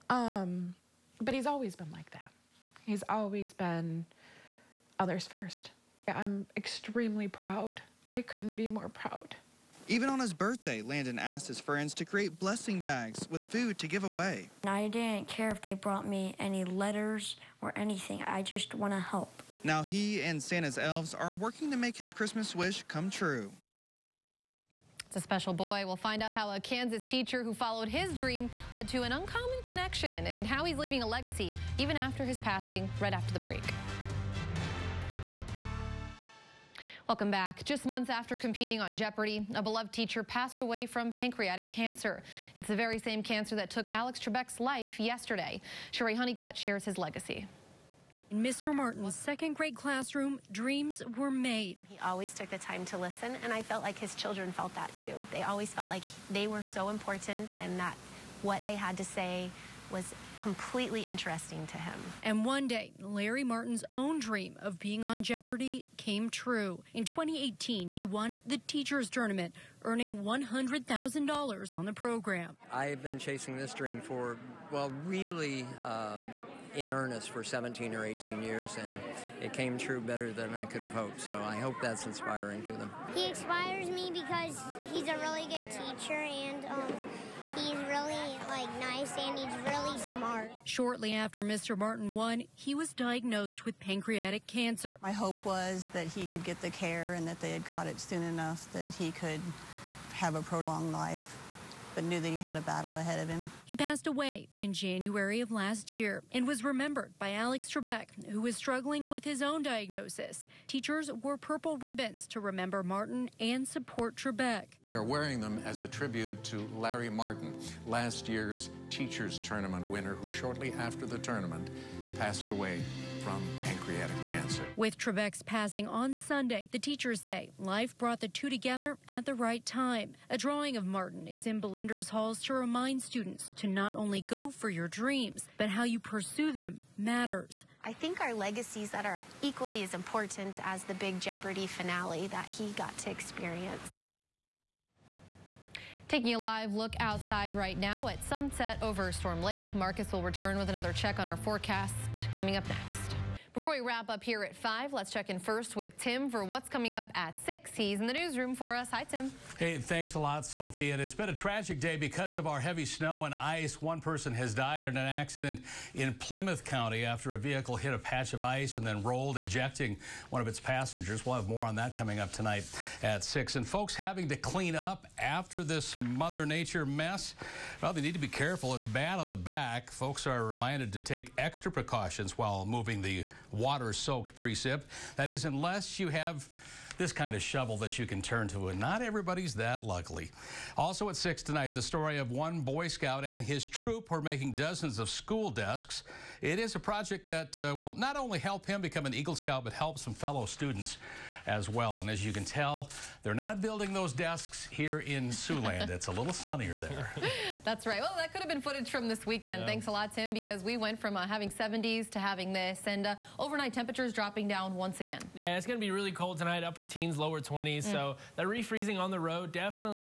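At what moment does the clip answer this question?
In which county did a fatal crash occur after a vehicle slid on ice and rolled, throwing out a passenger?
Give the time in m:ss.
2:46.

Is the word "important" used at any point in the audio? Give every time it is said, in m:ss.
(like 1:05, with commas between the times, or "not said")
0:56, 2:19.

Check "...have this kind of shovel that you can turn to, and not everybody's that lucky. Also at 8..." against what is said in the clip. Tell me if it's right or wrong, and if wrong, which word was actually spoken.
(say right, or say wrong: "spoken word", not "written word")
wrong: "6", not "8".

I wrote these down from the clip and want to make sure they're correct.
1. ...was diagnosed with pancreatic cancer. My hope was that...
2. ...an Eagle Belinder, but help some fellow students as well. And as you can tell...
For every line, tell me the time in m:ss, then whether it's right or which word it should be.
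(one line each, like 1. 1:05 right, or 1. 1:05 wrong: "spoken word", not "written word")
1. 1:32 right
2. 3:19 wrong: "Scout", not "Belinder".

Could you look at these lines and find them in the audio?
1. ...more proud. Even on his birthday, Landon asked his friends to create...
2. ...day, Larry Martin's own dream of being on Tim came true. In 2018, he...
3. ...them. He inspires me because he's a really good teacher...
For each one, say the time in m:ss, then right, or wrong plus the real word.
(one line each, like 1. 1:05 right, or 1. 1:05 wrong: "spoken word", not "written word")
1. 0:08 right
2. 1:02 wrong: "Jeopardy", not "Tim"
3. 1:22 right.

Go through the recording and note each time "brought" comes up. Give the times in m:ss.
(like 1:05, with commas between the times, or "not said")
0:15, 2:07.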